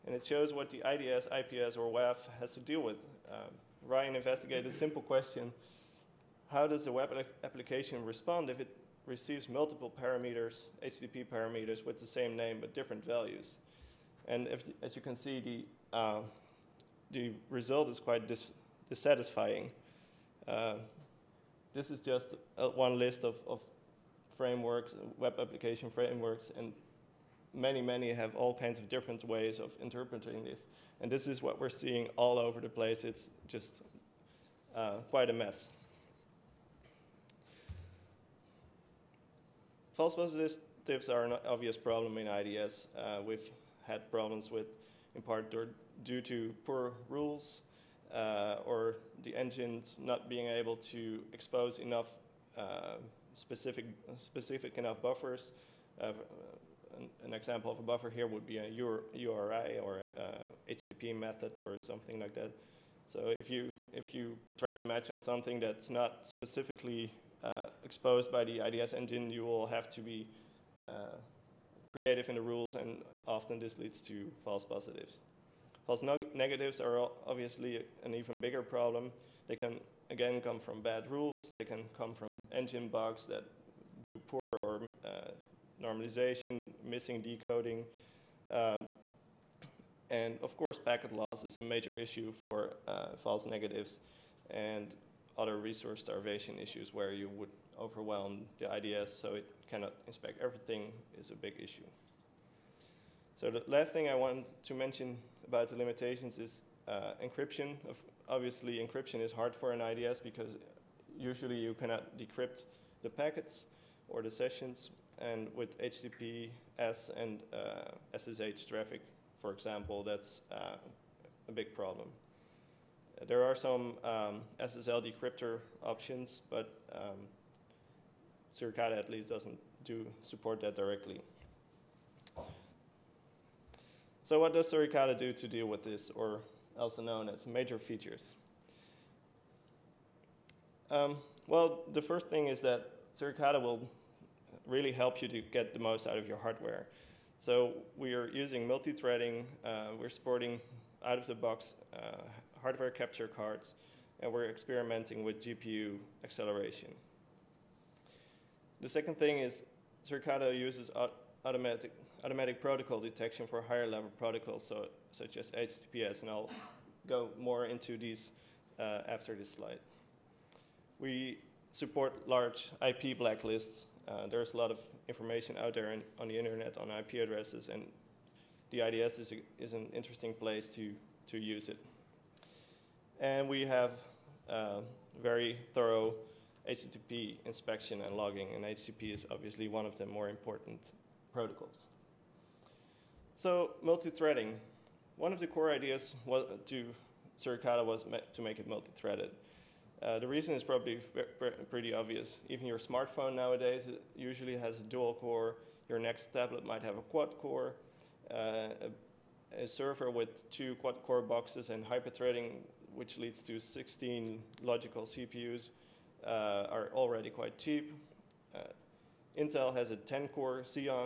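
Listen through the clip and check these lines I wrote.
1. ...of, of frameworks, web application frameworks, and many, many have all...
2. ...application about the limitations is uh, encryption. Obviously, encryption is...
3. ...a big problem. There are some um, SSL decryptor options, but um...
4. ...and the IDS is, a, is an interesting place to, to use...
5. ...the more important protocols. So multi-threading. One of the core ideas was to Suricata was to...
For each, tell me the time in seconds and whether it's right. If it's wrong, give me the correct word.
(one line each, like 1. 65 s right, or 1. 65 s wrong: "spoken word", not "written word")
1. 23 s right
2. 104 s wrong: "mention", not "application"
3. 121 s right
4. 177 s right
5. 189 s right.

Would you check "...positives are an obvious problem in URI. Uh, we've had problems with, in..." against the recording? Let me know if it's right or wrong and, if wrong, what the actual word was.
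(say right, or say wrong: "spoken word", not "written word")
wrong: "IDS", not "URI".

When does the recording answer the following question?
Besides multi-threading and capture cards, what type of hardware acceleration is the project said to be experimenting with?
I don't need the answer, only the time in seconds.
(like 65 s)
155 s.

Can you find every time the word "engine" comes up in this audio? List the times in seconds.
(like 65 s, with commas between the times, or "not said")
49 s, 68 s, 82 s.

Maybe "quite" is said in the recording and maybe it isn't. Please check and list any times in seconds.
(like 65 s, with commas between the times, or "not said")
17 s, 35 s, 217 s.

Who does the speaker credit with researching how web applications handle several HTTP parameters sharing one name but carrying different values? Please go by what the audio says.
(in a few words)
Ryan.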